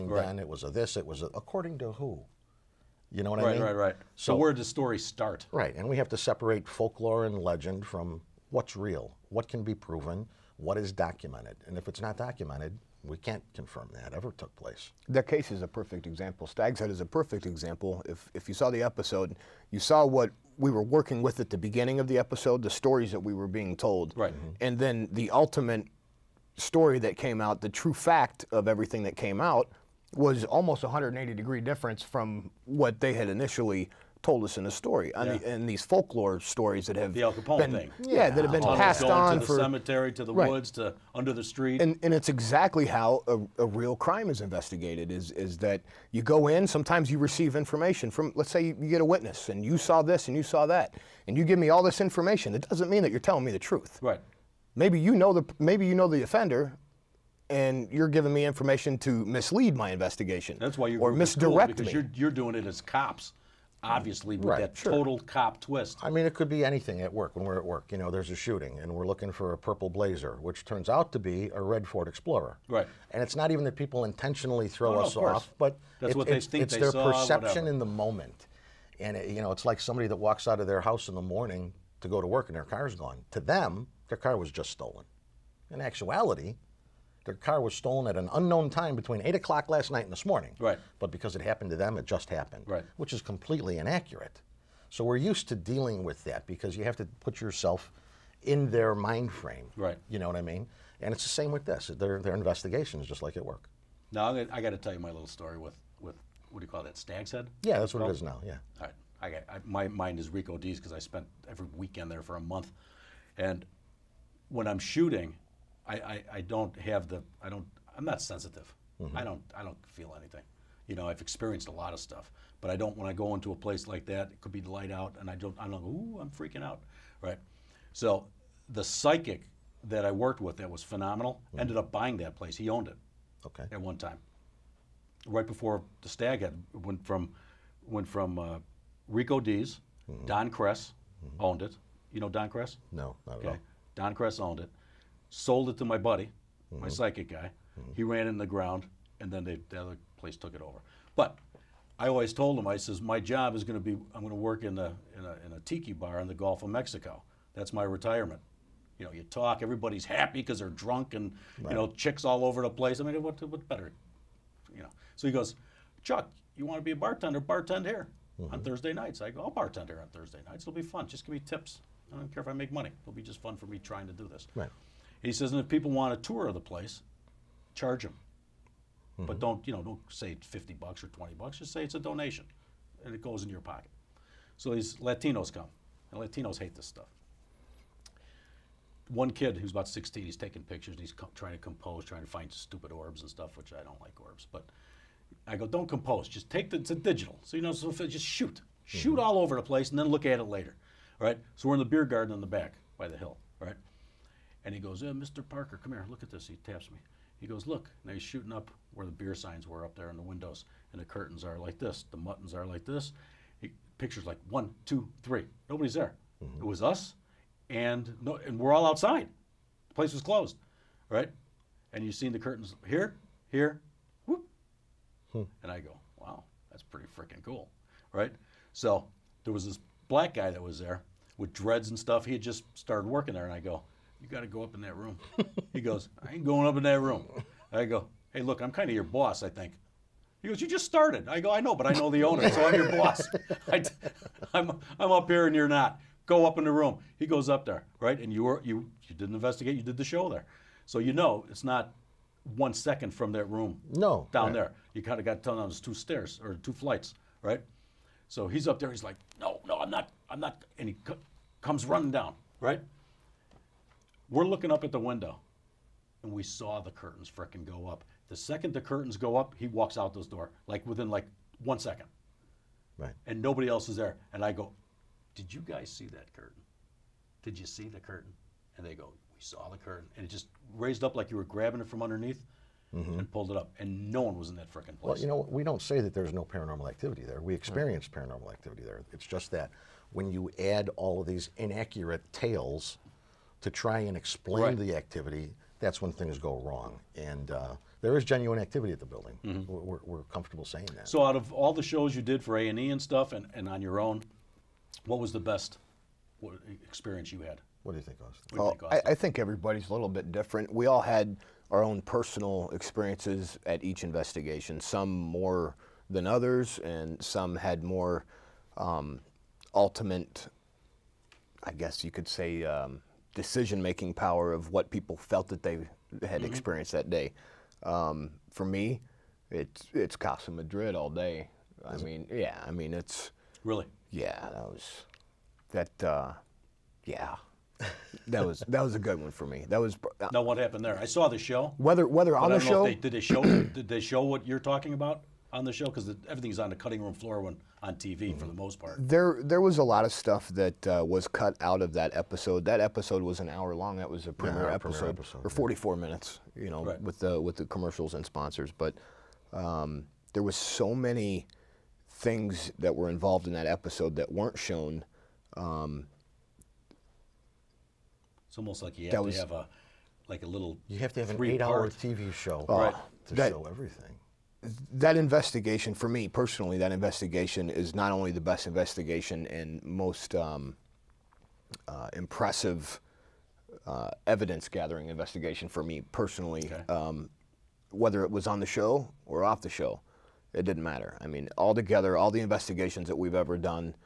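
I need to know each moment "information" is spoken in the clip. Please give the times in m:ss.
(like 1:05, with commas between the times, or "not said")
0:47, 0:51, 0:58.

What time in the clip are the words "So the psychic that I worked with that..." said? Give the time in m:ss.
2:07.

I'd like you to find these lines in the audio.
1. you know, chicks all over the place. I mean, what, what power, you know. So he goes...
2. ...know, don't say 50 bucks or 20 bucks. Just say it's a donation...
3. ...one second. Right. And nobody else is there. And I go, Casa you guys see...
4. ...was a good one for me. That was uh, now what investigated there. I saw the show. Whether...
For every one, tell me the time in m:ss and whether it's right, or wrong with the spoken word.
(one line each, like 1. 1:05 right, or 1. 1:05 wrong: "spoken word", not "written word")
1. 2:41 wrong: "better", not "power"
2. 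2:59 right
3. 4:31 wrong: "Did", not "Casa"
4. 5:38 wrong: "happened", not "investigated".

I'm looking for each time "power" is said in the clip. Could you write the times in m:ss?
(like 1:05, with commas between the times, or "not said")
5:24.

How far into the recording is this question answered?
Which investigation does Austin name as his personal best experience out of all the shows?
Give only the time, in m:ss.
5:30.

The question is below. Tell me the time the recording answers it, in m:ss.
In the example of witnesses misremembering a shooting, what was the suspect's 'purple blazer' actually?
1:11.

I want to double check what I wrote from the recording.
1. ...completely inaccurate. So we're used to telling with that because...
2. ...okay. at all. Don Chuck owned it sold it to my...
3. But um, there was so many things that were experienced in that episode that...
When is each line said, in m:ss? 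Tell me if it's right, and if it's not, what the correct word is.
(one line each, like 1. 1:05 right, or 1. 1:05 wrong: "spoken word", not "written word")
1. 1:33 wrong: "dealing", not "telling"
2. 2:23 wrong: "Cress", not "Chuck"
3. 5:58 wrong: "involved", not "experienced".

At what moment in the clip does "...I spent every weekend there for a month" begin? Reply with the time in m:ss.
1:50.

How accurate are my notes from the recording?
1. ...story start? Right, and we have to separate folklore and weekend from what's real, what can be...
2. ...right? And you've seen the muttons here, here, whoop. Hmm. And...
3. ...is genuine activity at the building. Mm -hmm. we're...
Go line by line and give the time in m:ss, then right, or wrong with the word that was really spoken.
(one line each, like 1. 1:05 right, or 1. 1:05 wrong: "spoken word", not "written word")
1. 0:04 wrong: "legend", not "weekend"
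2. 3:41 wrong: "curtains", not "muttons"
3. 4:58 right.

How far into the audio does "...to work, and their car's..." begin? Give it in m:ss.
1:22.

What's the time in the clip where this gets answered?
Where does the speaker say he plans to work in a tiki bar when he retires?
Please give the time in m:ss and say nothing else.
2:36.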